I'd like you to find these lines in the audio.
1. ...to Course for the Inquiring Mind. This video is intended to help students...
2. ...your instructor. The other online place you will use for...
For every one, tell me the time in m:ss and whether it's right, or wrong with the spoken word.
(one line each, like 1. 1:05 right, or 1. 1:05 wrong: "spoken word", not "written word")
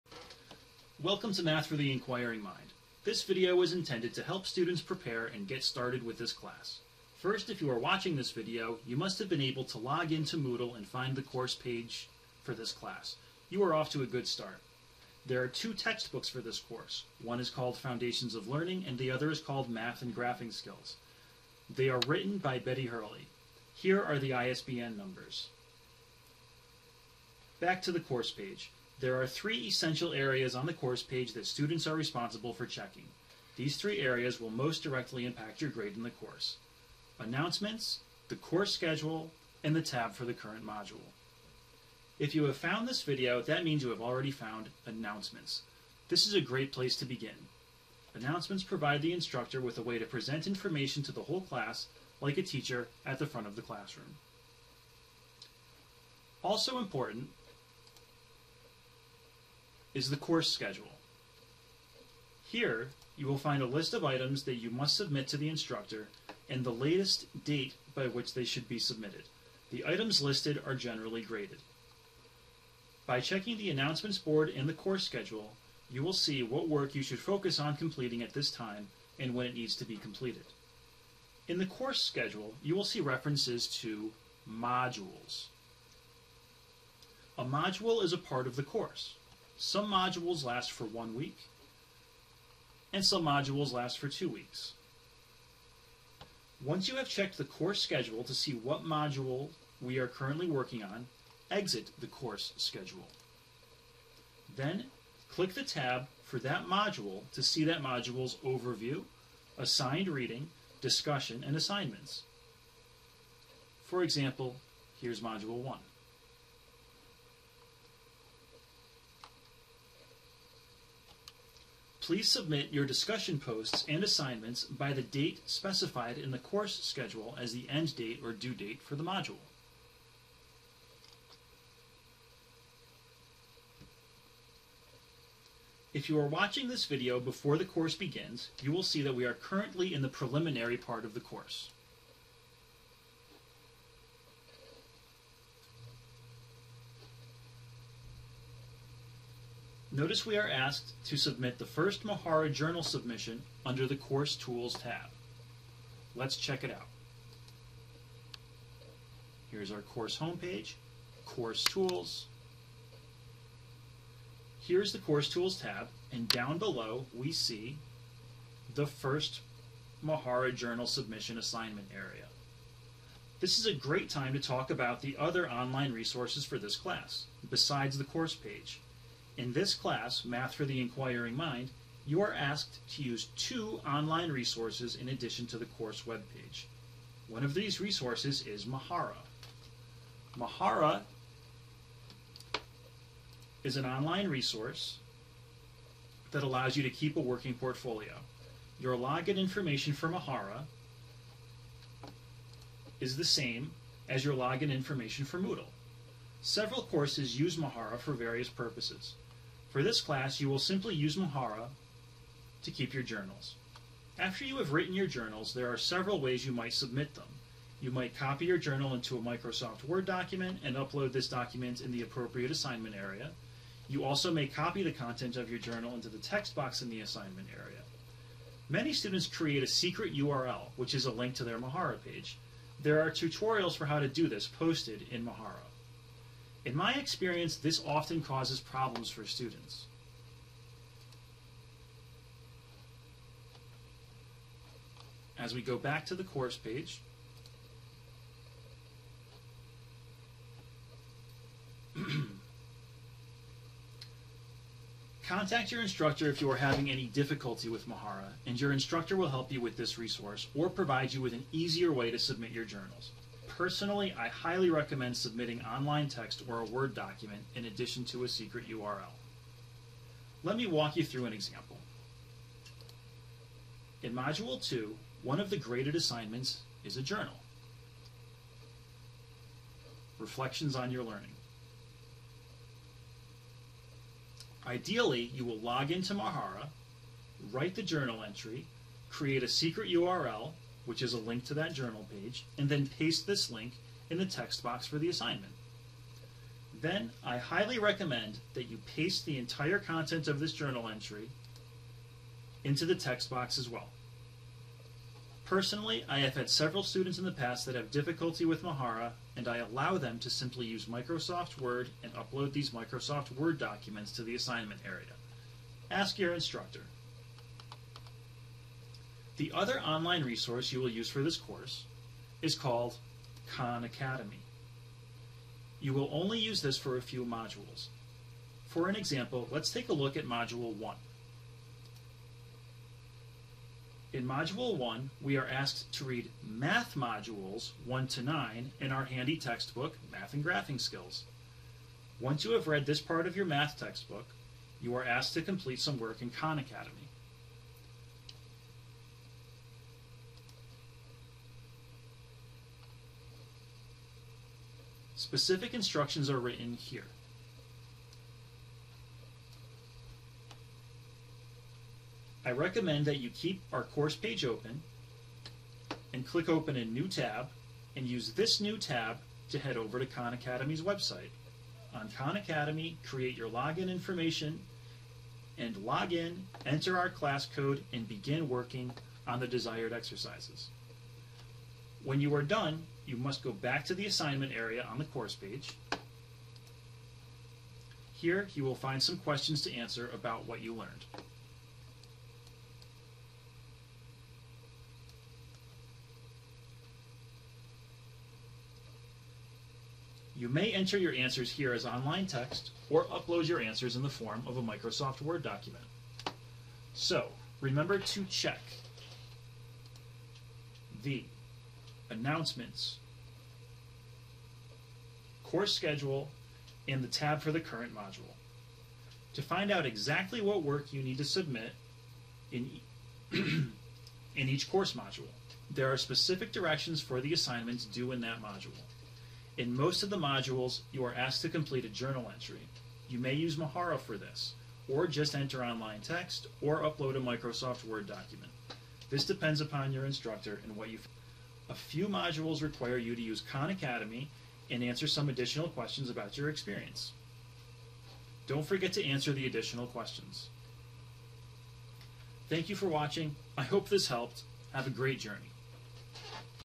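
1. 0:01 wrong: "Math", not "Course"
2. 5:16 wrong: "resource", not "place".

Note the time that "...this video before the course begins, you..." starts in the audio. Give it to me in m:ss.
2:16.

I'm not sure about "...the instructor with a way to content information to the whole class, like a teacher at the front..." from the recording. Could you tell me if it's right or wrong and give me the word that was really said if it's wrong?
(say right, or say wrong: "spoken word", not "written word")
wrong: "present", not "content".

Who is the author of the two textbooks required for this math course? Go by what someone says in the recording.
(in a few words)
Betty Hurley.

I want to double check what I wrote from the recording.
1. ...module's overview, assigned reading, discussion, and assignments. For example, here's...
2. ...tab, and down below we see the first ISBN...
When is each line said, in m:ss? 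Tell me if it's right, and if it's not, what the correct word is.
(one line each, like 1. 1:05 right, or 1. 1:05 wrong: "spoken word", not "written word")
1. 1:47 right
2. 2:45 wrong: "Mahara", not "ISBN".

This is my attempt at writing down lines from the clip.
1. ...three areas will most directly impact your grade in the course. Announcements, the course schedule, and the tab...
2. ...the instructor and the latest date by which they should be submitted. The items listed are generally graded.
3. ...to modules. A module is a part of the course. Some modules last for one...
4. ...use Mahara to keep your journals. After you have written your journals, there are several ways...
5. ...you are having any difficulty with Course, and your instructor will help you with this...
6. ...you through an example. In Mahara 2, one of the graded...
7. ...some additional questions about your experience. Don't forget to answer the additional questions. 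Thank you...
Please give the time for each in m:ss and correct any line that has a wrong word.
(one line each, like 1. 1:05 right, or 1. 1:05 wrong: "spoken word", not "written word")
1. 0:33 right
2. 1:05 right
3. 1:23 right
4. 3:30 right
5. 4:16 wrong: "Mahara", not "Course"
6. 4:30 wrong: "Module", not "Mahara"
7. 7:25 right.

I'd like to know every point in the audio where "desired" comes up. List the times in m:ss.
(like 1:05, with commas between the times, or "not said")
6:19.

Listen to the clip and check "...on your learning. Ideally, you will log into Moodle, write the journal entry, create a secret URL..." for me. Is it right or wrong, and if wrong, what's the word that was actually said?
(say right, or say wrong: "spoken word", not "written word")
wrong: "Mahara", not "Moodle".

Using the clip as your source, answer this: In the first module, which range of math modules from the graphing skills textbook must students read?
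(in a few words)
1 to 9.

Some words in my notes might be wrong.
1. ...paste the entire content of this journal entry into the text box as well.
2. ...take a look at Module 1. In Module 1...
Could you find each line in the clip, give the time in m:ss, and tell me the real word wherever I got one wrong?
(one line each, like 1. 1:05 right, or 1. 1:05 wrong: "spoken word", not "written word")
1. 4:58 right
2. 5:29 right.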